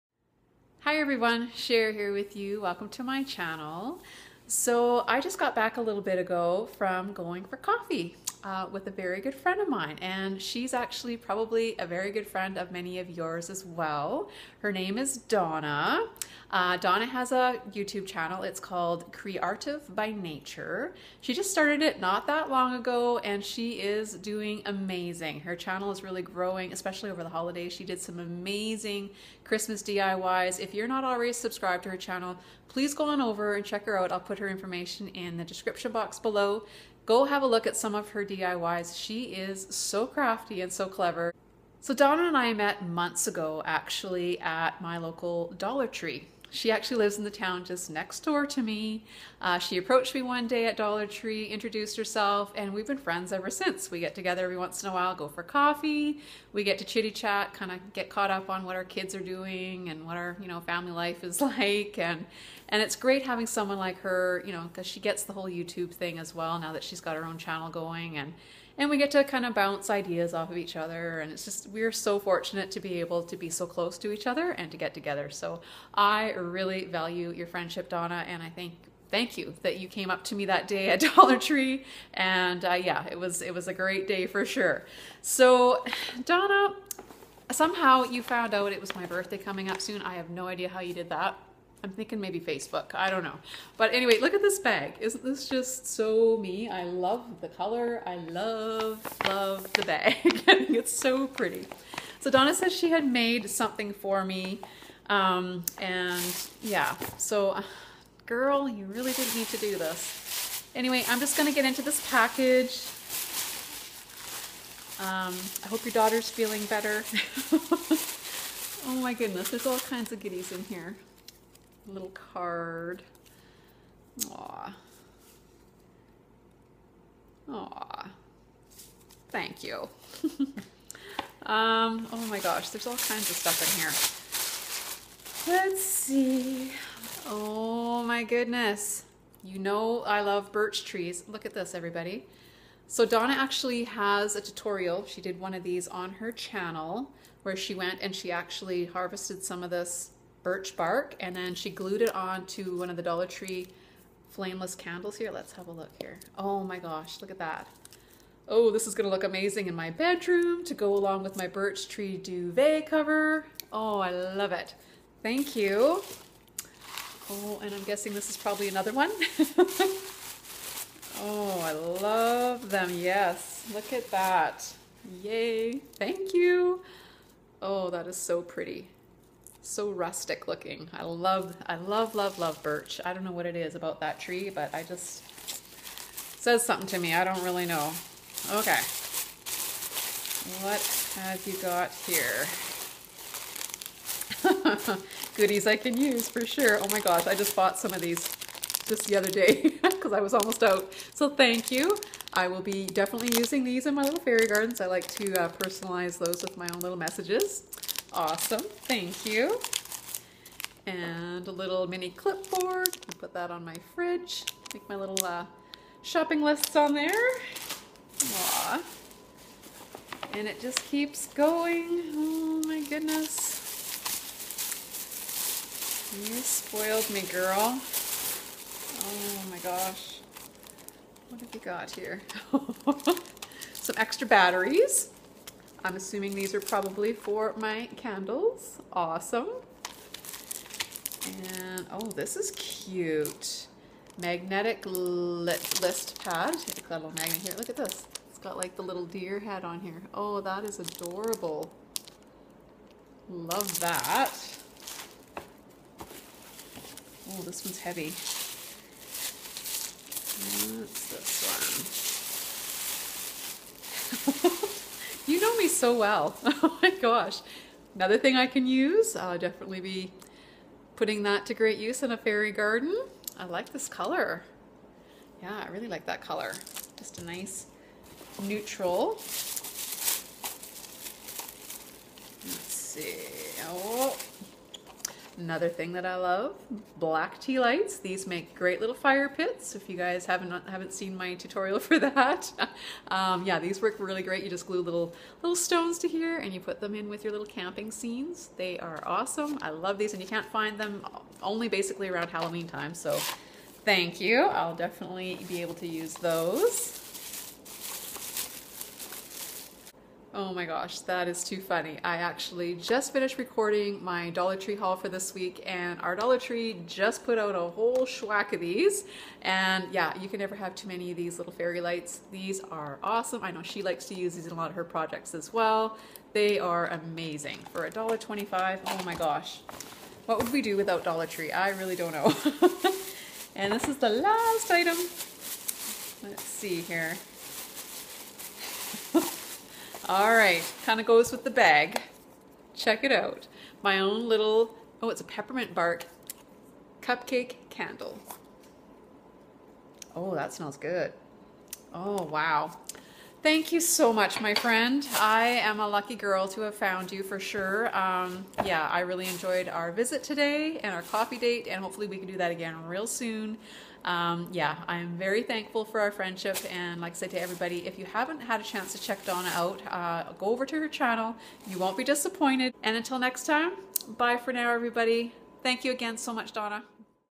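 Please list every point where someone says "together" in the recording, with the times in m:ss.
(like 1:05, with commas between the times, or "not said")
0:54, 1:14.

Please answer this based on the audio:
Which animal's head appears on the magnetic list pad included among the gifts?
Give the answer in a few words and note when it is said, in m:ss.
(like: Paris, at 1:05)
deer, at 4:09.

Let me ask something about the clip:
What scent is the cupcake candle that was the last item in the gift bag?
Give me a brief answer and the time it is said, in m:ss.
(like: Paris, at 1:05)
peppermint bark, at 5:45.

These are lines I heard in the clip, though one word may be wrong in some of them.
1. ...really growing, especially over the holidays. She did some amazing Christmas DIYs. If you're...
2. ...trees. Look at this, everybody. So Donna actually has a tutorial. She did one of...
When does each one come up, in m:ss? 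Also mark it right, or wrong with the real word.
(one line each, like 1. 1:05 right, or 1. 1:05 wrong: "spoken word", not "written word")
1. 0:26 right
2. 2:20 right.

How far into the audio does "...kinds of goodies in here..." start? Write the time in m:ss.
1:59.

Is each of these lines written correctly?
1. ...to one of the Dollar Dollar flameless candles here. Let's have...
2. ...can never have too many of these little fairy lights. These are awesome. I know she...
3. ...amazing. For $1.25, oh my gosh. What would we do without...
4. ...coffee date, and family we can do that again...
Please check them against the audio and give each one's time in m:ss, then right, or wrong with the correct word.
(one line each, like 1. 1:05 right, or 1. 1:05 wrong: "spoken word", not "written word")
1. 2:32 wrong: "Tree", not "Dollar"
2. 5:20 right
3. 5:26 right
4. 6:01 wrong: "hopefully", not "family".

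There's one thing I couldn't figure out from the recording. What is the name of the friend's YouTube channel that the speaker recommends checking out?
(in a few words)
Creative by Nature.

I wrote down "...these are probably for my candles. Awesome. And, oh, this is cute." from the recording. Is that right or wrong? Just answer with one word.
right.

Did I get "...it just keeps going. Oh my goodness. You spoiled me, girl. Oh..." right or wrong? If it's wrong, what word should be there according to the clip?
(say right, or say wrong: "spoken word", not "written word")
right.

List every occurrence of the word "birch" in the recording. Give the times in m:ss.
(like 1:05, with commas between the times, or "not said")
2:20, 2:30, 2:41, 3:02.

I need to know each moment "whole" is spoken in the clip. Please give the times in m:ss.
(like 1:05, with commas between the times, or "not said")
1:05, 5:17.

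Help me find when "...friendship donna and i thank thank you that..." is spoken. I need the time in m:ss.
1:17.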